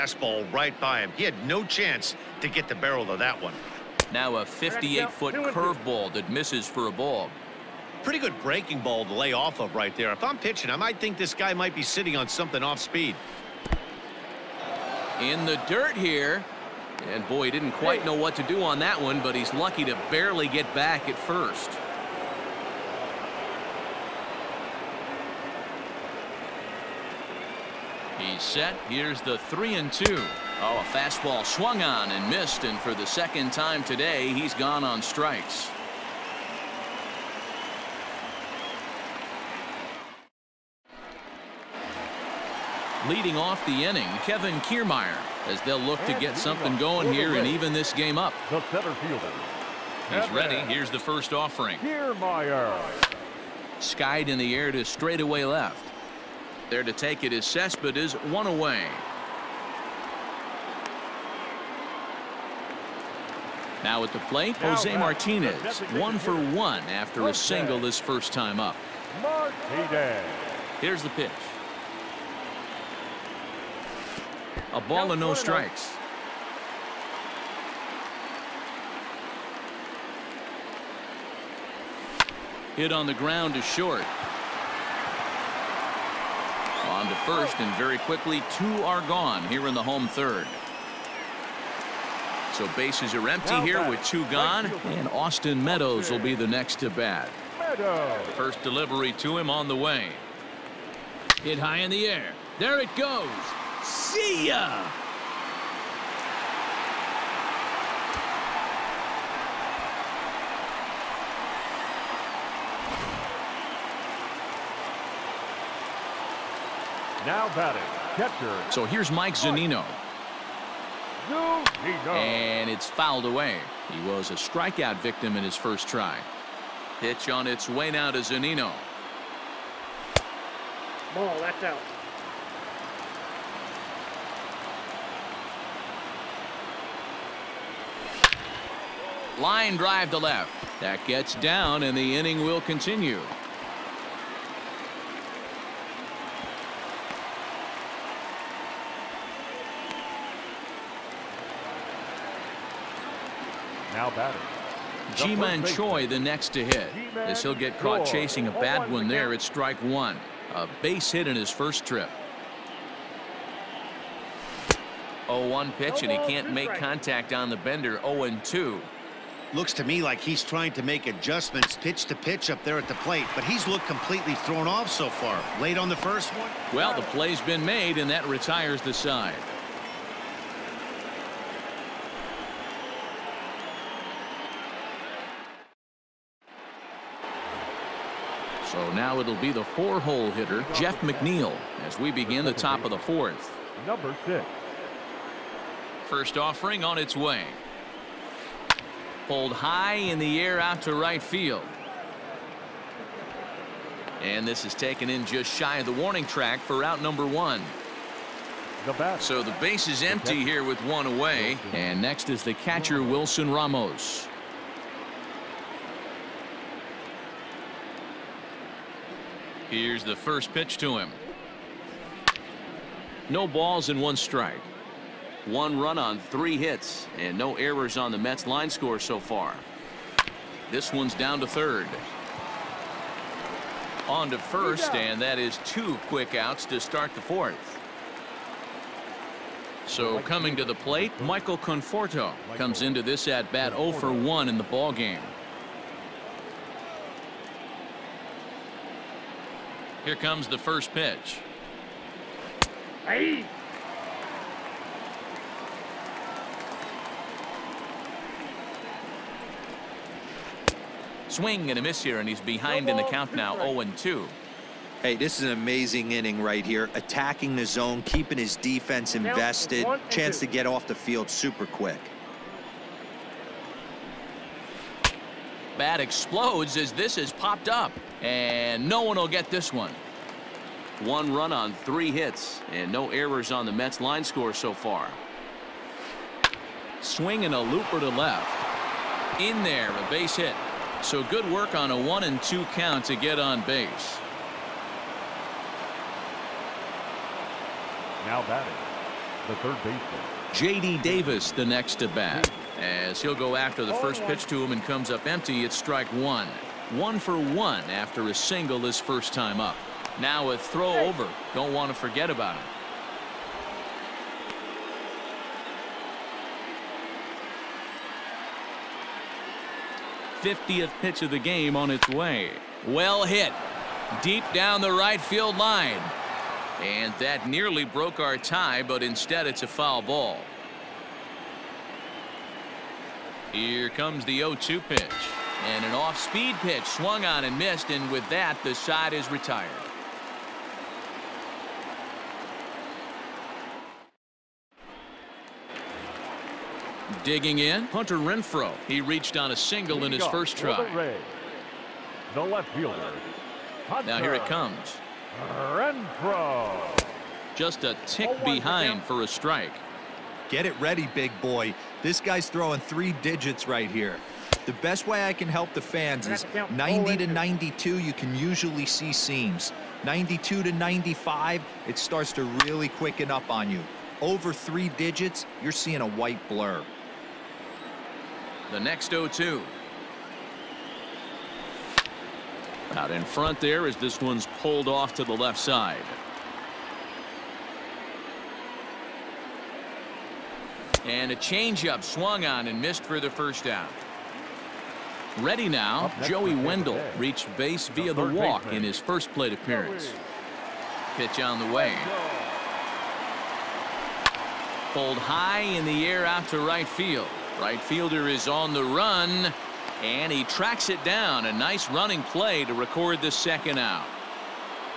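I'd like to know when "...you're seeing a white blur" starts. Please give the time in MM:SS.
06:15.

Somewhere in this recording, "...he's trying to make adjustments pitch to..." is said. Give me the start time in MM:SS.
02:50.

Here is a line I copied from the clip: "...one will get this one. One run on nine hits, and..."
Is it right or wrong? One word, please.
wrong.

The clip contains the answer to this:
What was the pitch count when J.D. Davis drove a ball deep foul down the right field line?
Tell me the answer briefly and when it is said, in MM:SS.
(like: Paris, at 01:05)
50, at 05:20.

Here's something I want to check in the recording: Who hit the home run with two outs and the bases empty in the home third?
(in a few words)
Austin Meadows.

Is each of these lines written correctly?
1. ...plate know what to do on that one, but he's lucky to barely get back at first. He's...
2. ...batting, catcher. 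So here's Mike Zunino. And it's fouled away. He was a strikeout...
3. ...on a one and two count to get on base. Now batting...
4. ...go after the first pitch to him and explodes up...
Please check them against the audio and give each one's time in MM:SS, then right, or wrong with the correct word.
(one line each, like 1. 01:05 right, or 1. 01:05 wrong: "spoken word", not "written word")
1. 00:17 wrong: "quite", not "plate"
2. 01:57 right
3. 04:51 right
4. 05:03 wrong: "comes", not "explodes".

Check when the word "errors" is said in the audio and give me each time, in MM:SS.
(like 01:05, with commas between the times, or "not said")
03:47, 04:43.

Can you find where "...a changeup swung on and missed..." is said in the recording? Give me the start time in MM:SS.
06:31.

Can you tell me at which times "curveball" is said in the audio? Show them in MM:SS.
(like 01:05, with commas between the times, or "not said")
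00:05.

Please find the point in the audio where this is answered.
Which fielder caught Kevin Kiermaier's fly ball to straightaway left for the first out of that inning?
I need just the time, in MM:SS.
00:57.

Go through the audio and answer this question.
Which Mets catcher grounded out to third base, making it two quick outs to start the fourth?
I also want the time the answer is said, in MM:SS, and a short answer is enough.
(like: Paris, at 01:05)
Wilson Ramos, at 03:33.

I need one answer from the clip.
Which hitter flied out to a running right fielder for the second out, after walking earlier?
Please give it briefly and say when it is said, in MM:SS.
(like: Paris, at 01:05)
Joey Wendle, at 06:36.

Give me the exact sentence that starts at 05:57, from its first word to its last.
Just a tick behind for a strike.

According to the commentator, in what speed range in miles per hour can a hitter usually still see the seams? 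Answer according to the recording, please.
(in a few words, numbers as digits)
90 to 92.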